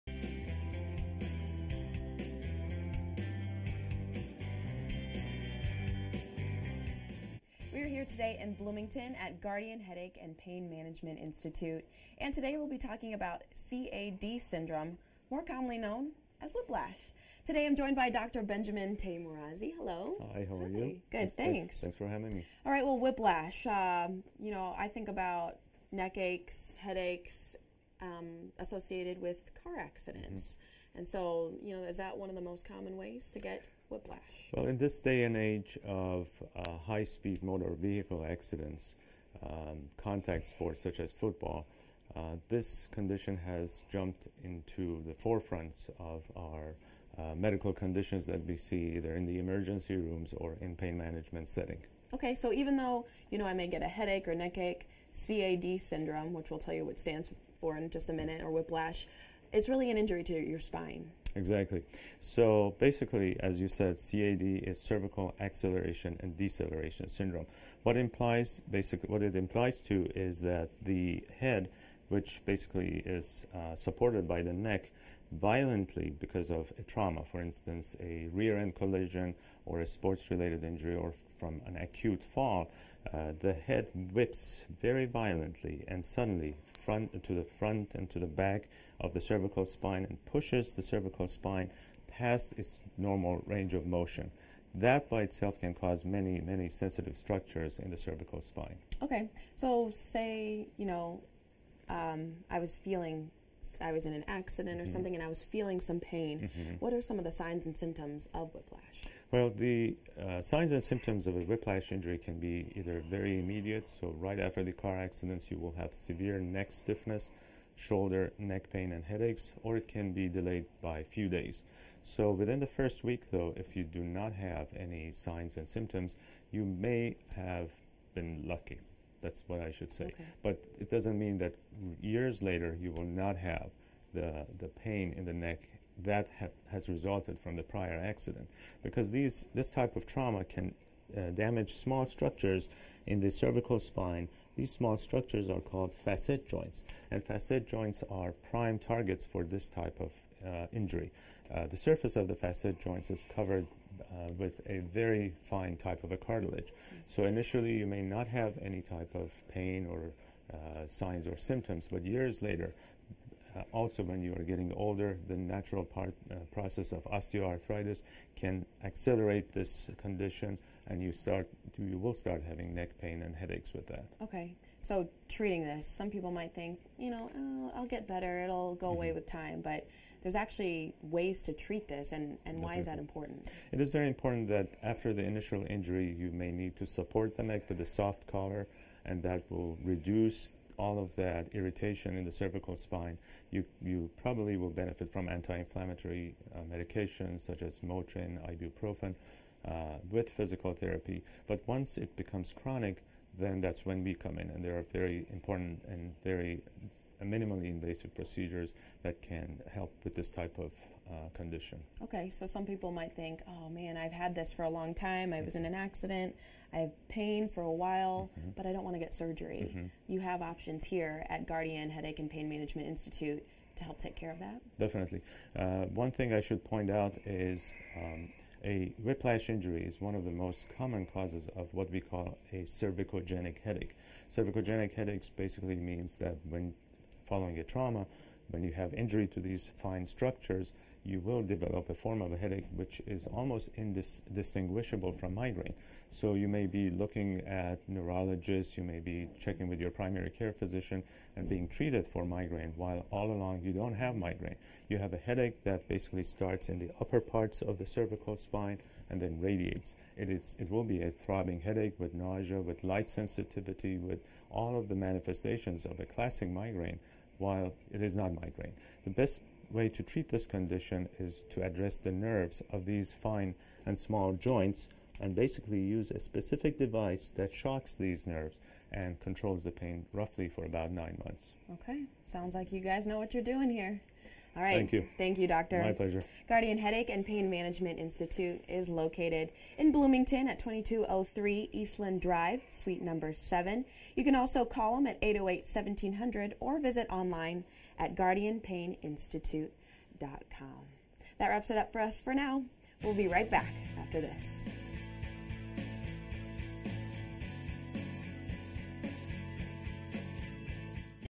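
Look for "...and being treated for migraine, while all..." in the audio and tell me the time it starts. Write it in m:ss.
4:11.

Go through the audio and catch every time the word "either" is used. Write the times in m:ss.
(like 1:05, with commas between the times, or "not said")
0:48, 1:52.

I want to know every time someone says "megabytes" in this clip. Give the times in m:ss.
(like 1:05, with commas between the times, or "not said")
not said.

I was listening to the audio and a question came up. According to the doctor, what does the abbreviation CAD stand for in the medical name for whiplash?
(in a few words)
cervical acceleration and deceleration.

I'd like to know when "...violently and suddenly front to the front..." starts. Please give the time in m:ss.
1:25.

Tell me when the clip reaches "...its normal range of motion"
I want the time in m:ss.
1:32.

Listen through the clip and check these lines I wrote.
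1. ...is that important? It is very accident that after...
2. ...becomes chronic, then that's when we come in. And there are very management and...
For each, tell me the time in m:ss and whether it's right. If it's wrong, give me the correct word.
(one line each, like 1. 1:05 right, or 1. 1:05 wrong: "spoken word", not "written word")
1. 3:02 wrong: "important", not "accident"
2. 3:22 wrong: "important", not "management".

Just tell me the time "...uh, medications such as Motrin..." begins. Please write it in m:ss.
3:16.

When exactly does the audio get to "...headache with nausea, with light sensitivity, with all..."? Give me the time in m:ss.
4:21.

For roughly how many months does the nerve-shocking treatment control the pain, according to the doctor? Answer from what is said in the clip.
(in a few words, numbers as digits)
9.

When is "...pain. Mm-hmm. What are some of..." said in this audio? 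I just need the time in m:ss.
1:45.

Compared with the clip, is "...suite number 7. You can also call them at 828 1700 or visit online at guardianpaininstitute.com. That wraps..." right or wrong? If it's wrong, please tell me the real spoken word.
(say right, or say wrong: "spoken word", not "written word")
wrong: "808", not "828".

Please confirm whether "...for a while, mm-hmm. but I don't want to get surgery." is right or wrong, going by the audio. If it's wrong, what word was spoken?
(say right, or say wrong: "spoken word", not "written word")
right.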